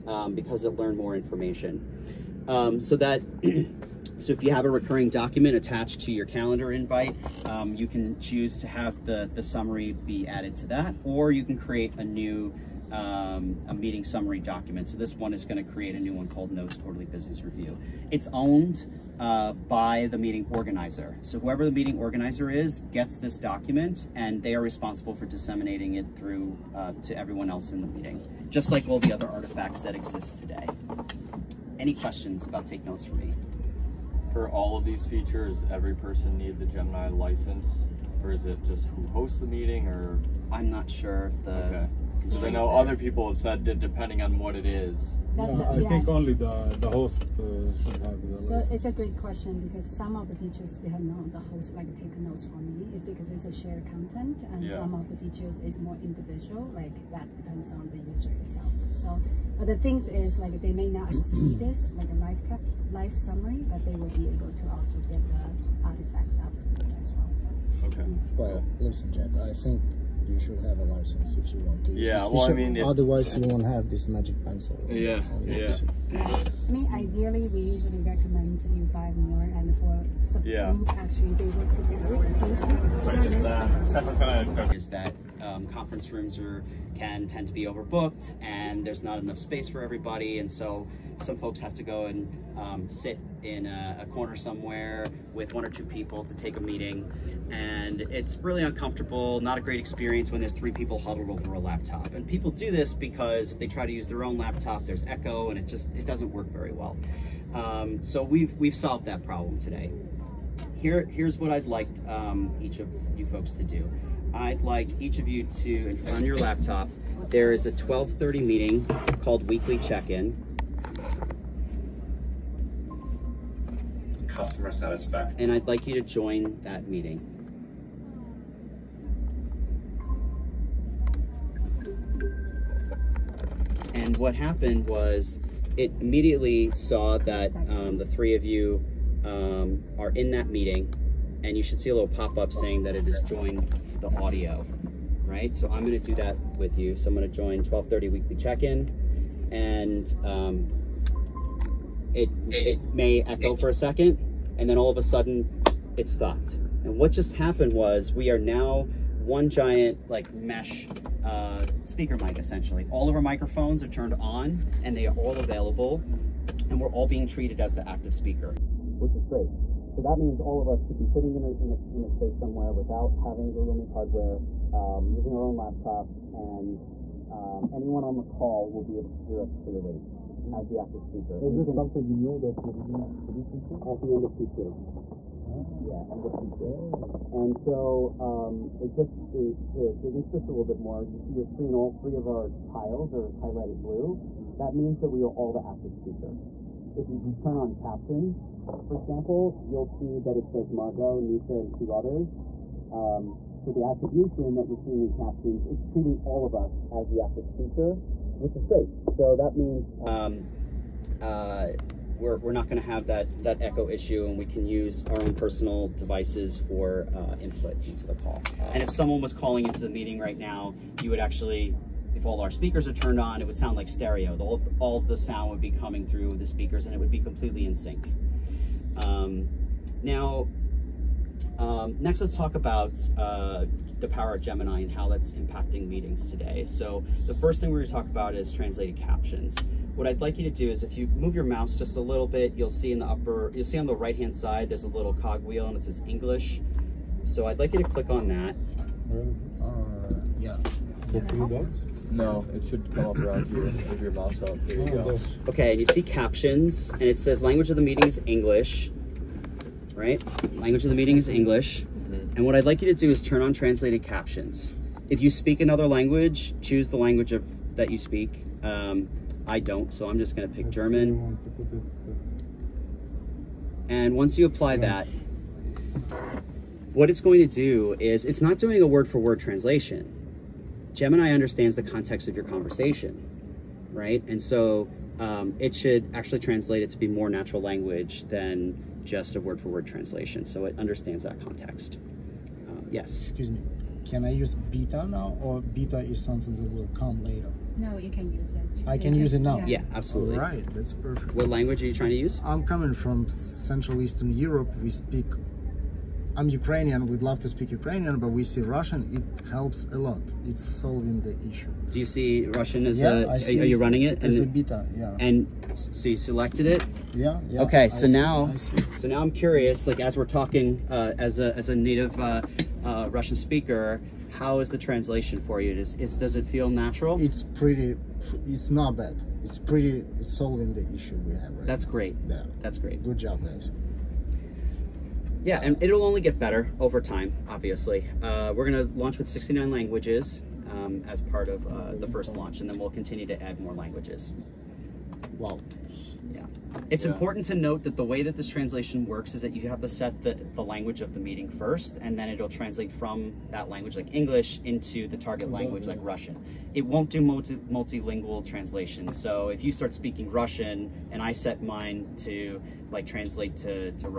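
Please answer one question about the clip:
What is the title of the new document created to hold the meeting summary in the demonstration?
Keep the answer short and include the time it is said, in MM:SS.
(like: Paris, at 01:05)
Notes Quarterly Business Review, at 00:16.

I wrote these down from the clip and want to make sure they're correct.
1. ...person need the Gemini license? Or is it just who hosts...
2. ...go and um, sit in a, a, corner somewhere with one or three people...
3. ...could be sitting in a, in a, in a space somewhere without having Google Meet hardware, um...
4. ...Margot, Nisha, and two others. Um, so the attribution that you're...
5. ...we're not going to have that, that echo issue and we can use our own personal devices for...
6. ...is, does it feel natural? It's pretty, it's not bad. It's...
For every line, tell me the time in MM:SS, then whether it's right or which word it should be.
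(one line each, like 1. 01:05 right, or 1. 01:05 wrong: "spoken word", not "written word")
1. 00:35 right
2. 01:31 wrong: "two", not "three"
3. 02:50 right
4. 03:20 right
5. 03:32 right
6. 05:25 right.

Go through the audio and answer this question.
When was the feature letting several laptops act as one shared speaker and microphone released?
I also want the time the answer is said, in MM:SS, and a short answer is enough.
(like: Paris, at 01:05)
End of Q2, at 03:03.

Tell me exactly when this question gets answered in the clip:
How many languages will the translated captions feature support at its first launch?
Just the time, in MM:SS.
05:39.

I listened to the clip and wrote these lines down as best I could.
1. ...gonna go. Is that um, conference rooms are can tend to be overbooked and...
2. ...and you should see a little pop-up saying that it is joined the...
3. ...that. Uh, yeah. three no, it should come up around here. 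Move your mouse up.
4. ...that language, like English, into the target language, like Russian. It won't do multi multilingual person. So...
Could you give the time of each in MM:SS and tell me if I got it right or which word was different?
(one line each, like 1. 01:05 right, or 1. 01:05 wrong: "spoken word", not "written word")
1. 01:24 right
2. 02:21 right
3. 04:08 right
4. 05:53 wrong: "translation", not "person".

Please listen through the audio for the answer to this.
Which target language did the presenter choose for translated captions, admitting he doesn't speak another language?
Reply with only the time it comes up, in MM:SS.
04:30.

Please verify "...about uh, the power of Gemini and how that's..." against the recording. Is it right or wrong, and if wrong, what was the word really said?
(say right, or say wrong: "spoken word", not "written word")
right.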